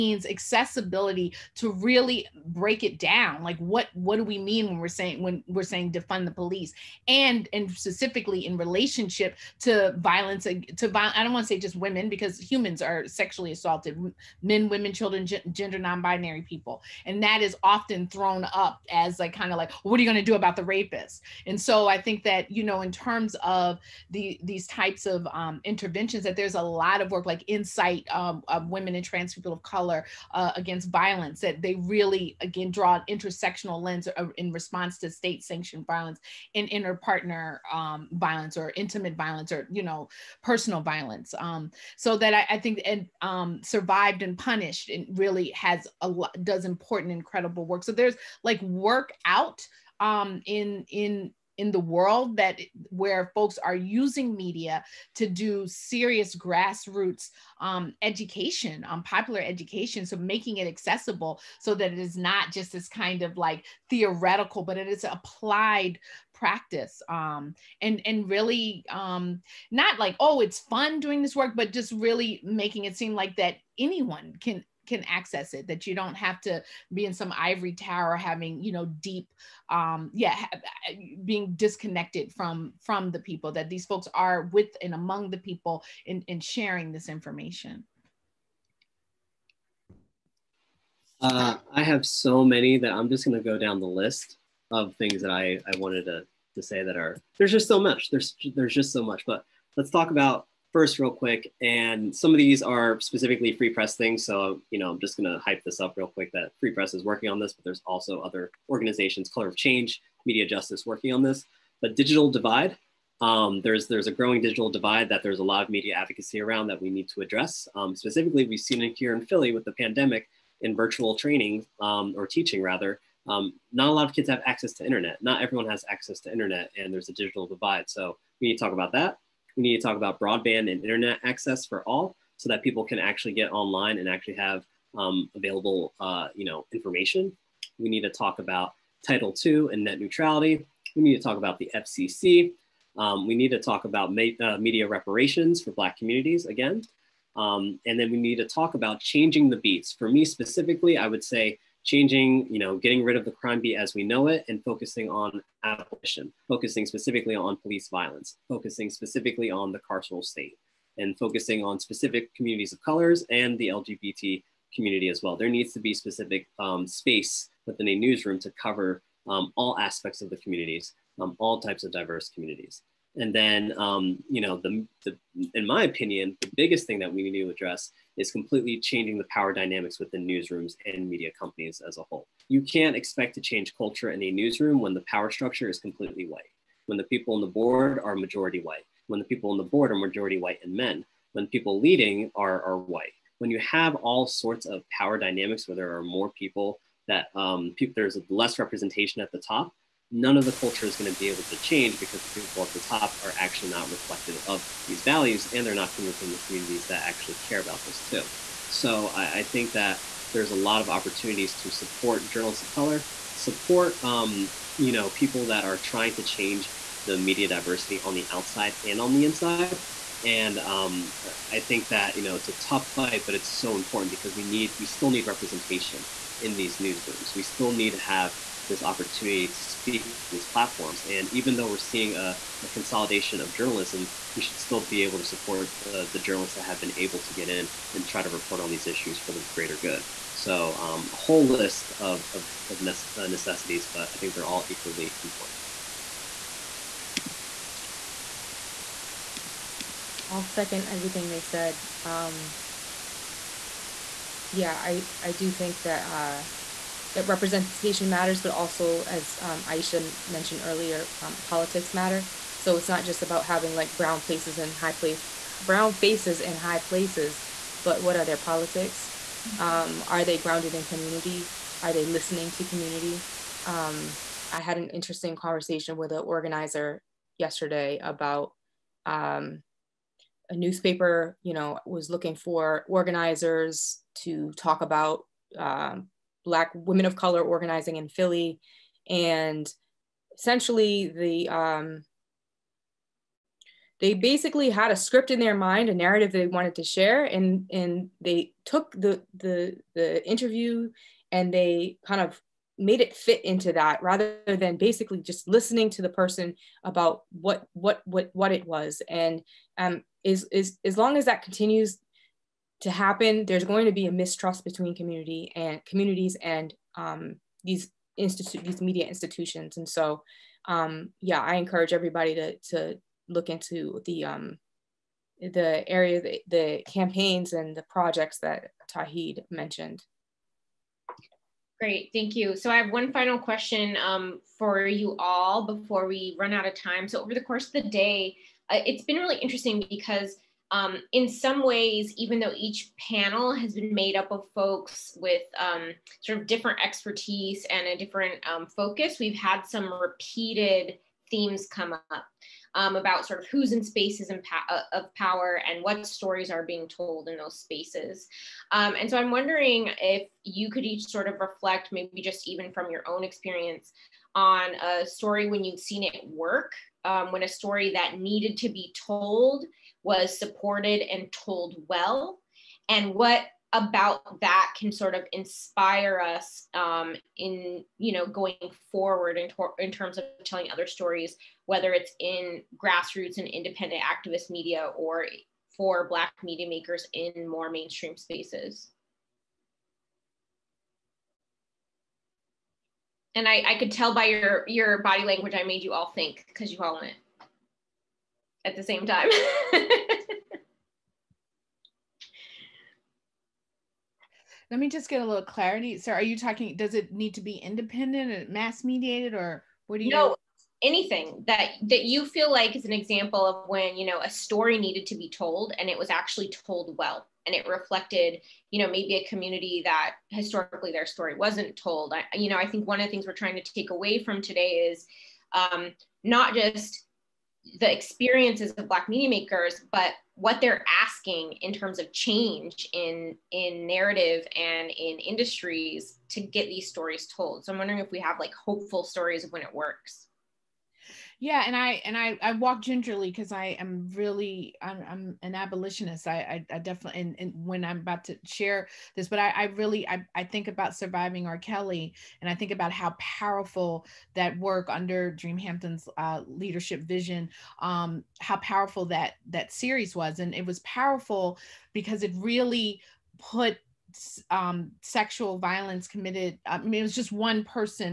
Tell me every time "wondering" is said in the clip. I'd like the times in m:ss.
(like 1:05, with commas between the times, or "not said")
5:59, 7:17.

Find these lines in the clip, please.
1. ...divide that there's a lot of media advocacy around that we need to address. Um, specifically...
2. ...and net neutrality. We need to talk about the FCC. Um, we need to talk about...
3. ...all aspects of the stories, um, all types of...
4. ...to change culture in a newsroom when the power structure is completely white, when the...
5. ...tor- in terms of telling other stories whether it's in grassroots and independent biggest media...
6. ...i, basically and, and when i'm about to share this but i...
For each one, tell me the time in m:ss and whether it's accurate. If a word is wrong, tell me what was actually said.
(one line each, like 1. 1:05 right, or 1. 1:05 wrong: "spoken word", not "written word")
1. 1:54 right
2. 2:19 right
3. 2:49 wrong: "communities", not "stories"
4. 3:03 right
5. 6:19 wrong: "activist", not "biggest"
6. 7:26 wrong: "definitely", not "basically".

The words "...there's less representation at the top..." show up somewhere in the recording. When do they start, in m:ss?
3:17.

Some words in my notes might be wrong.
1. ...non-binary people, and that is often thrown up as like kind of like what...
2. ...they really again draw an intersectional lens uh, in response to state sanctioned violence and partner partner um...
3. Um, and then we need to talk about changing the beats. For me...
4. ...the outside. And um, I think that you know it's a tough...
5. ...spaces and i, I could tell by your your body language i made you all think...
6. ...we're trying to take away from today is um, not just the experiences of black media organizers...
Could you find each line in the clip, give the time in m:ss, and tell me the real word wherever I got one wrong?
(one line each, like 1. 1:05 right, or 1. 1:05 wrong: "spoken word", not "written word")
1. 0:15 right
2. 0:31 wrong: "inner", not "partner"
3. 2:27 right
4. 3:39 wrong: "inside", not "outside"
5. 6:28 right
6. 7:03 wrong: "makers", not "organizers".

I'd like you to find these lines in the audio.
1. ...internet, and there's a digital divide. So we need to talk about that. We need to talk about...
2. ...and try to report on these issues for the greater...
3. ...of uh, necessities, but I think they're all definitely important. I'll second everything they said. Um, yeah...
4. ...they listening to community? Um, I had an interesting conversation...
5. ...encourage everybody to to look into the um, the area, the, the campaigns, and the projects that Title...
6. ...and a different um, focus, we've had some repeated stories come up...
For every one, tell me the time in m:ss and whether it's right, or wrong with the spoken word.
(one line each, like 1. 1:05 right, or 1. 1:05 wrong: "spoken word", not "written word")
1. 2:06 right
2. 3:57 right
3. 4:02 wrong: "equally", not "definitely"
4. 4:31 right
5. 5:21 wrong: "Tauhid", not "Title"
6. 5:47 wrong: "themes", not "stories".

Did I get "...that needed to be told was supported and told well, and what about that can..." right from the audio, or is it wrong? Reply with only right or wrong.
right.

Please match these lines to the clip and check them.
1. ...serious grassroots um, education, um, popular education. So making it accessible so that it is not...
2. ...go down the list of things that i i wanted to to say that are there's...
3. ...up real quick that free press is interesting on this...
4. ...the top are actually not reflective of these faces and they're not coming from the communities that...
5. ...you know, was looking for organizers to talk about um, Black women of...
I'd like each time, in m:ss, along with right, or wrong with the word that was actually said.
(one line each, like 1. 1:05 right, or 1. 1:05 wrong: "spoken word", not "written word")
1. 0:55 right
2. 1:33 right
3. 1:45 wrong: "working", not "interesting"
4. 3:22 wrong: "values", not "faces"
5. 4:41 right.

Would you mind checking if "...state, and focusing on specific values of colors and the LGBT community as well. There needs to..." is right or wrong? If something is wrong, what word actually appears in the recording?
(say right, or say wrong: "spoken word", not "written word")
wrong: "communities", not "values".